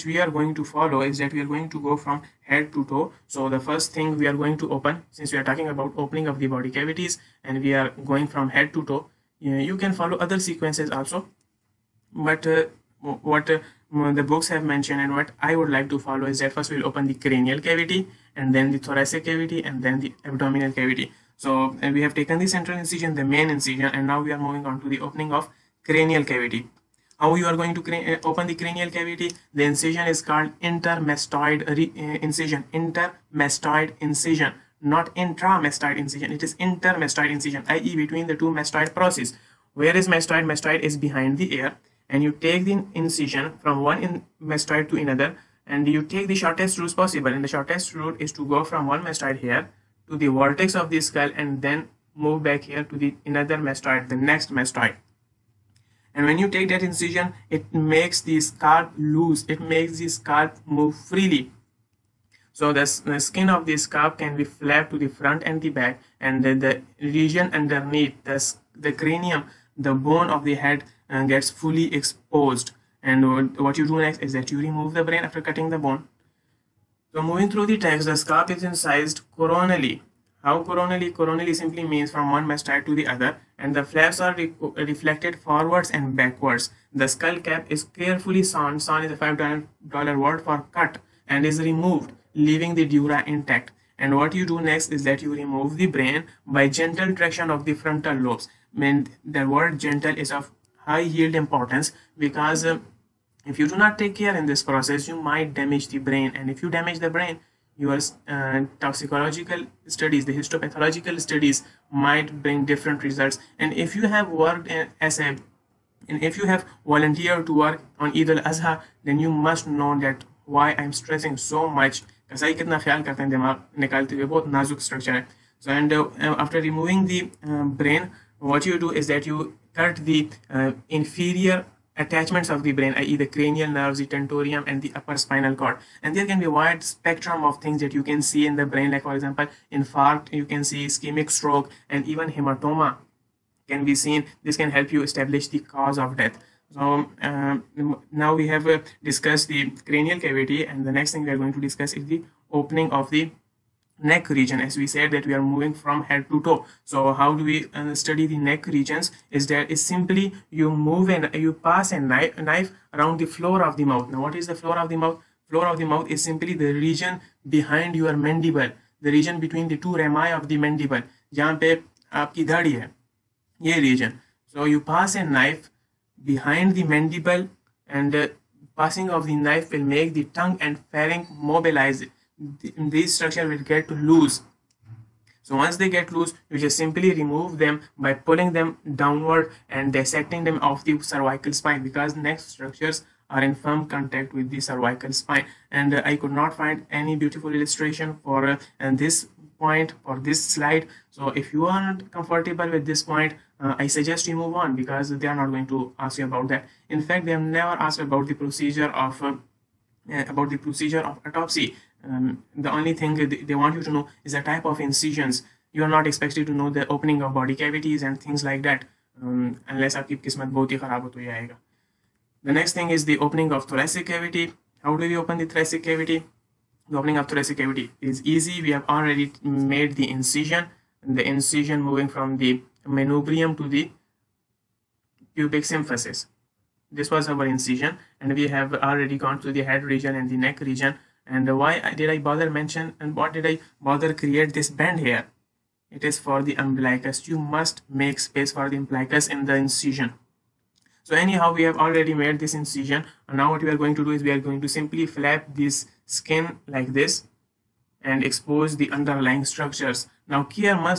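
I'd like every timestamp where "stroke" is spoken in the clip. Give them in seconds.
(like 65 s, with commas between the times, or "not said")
141 s.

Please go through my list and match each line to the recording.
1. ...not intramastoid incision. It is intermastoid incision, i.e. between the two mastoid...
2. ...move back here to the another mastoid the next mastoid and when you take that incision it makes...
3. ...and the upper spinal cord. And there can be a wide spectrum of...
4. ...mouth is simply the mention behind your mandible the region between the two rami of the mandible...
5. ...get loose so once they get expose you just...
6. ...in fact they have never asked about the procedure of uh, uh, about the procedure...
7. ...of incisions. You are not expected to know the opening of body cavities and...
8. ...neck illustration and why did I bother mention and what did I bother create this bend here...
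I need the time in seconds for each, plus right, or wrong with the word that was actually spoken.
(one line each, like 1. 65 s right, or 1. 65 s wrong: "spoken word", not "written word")
1. 34 s right
2. 52 s right
3. 134 s right
4. 165 s wrong: "region", not "mention"
5. 183 s wrong: "loose", not "expose"
6. 206 s right
7. 214 s right
8. 240 s wrong: "region", not "illustration".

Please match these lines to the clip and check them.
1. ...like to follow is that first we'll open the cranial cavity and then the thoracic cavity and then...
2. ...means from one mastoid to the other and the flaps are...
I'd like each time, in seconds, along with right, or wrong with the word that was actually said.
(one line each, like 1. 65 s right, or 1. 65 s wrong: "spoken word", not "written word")
1. 15 s right
2. 81 s right.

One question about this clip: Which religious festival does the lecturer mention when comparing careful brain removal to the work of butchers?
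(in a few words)
Eid al-Azha.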